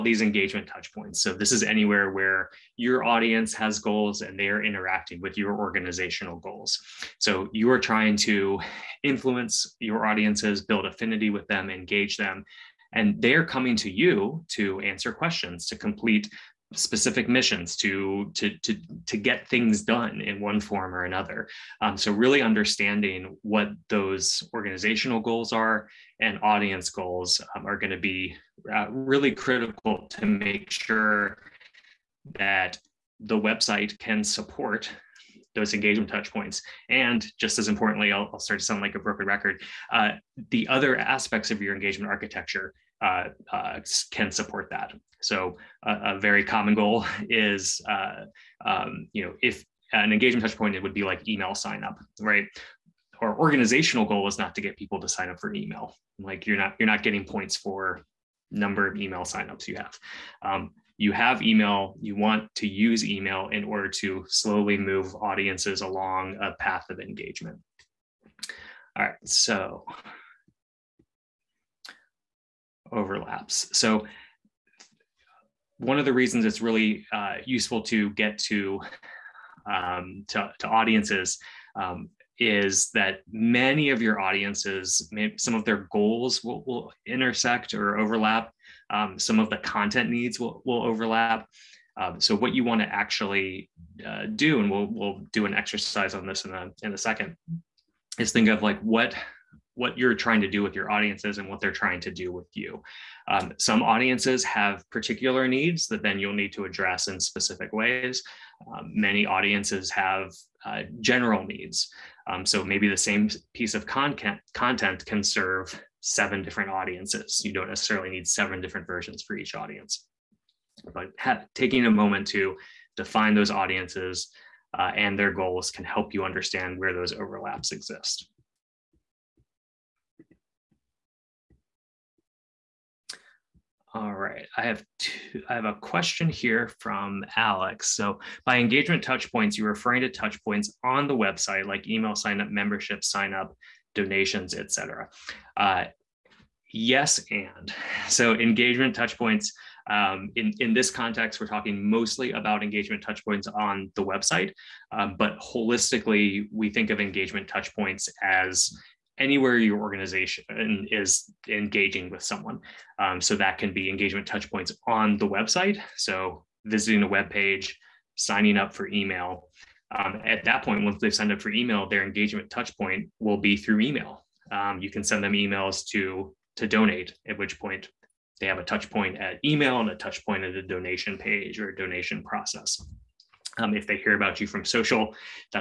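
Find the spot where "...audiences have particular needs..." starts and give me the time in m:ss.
1:43.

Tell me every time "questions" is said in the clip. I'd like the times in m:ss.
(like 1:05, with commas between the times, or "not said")
0:15, 2:15.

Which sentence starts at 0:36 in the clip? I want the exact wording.
And just as importantly, I'll, I'll, start to sound like a broken record.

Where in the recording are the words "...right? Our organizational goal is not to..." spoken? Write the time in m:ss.
0:52.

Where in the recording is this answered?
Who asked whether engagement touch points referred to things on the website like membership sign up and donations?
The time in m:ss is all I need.
2:17.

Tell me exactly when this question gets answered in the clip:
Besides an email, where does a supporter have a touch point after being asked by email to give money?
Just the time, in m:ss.
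3:00.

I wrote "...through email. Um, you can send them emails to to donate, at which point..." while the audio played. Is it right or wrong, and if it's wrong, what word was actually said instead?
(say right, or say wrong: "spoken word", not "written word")
right.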